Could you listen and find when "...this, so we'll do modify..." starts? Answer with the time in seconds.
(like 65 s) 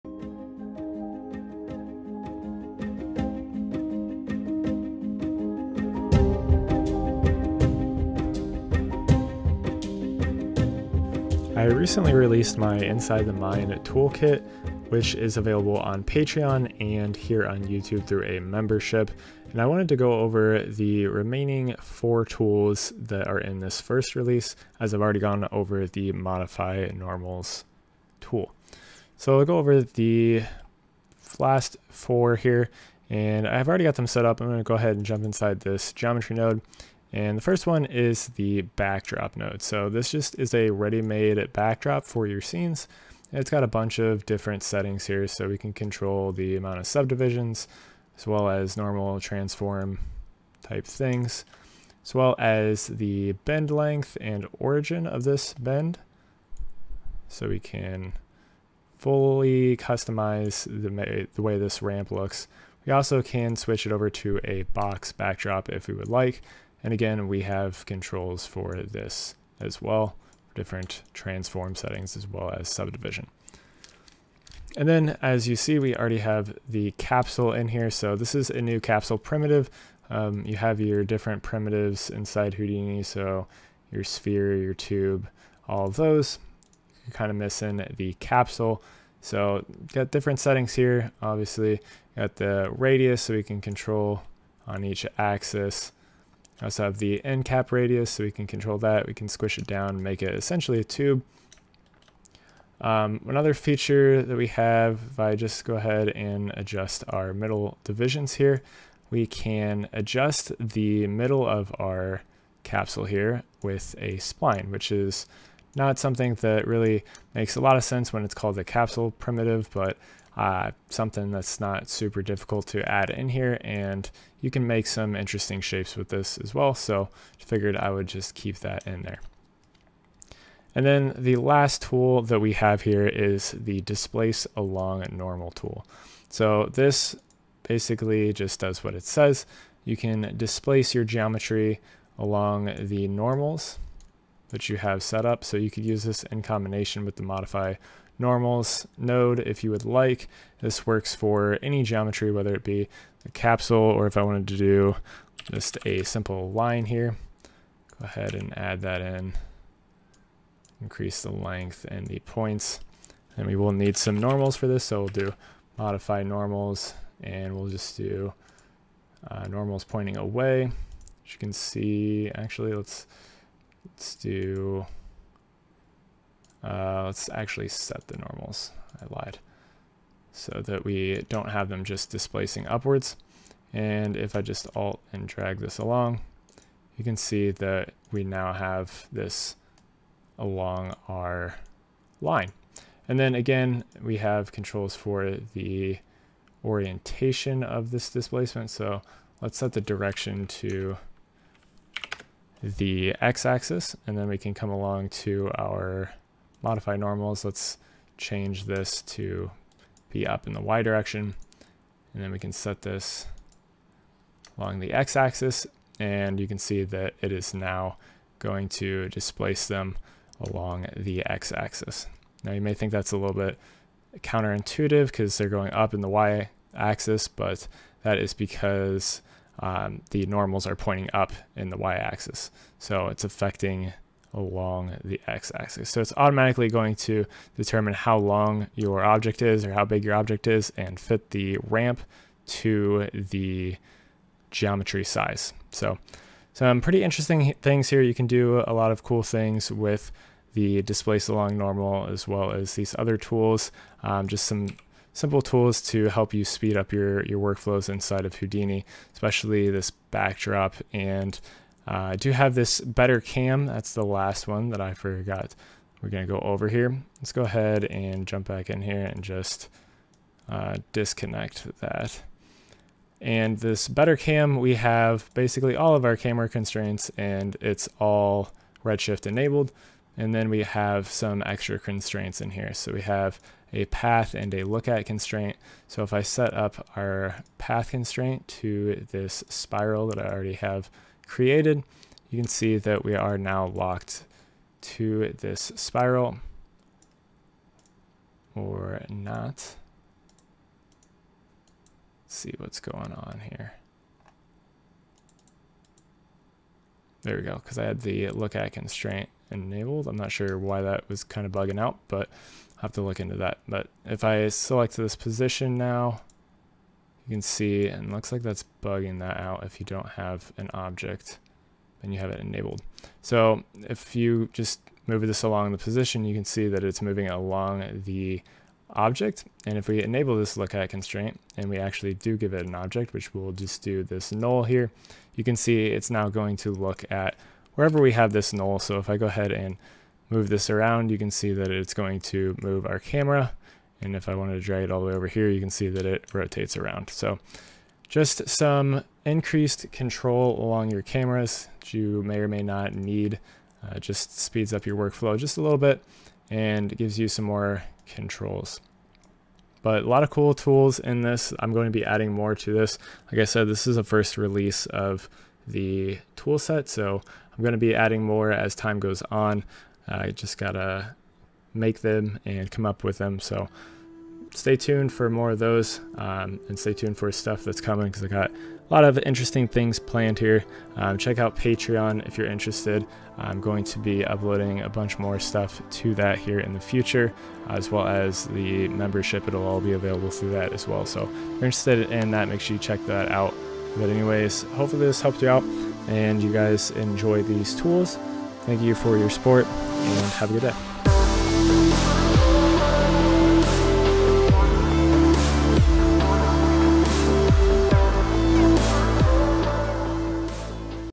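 164 s.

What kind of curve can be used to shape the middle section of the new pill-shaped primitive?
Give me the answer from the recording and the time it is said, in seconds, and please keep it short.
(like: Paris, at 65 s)
Spline, at 114 s.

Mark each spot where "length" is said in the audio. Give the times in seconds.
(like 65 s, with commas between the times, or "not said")
53 s, 161 s.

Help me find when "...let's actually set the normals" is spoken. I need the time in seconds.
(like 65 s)
177 s.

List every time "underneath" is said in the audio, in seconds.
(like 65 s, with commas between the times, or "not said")
not said.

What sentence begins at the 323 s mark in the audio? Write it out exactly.
So if you just move this along the position, you can see that it's moving along the object.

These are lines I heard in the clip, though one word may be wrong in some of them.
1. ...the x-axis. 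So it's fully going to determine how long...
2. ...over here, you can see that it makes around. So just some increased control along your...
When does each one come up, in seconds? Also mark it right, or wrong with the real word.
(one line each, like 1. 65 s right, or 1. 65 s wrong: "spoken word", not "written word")
1. 235 s wrong: "automatically", not "fully"
2. 345 s wrong: "rotates", not "makes".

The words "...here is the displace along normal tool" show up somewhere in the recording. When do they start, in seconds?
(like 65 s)
132 s.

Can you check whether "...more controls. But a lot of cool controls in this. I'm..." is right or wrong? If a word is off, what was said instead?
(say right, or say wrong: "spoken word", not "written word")
wrong: "tools", not "controls".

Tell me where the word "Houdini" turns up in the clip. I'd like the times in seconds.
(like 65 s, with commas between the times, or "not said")
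82 s, 258 s.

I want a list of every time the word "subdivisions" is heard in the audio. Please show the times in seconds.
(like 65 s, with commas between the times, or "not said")
46 s, 72 s.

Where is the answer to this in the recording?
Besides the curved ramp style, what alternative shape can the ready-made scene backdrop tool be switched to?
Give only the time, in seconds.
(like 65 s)
64 s.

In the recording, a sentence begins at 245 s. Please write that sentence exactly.
So some pretty interesting things here.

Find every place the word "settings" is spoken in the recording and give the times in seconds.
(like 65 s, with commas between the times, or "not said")
44 s, 71 s, 90 s.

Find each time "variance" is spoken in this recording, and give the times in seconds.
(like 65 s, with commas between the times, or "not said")
not said.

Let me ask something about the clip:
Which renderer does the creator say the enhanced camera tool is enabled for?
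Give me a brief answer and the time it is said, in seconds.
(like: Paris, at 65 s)
Redshift, at 278 s.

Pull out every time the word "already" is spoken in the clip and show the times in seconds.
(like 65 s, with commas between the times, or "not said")
25 s, 33 s, 75 s, 290 s.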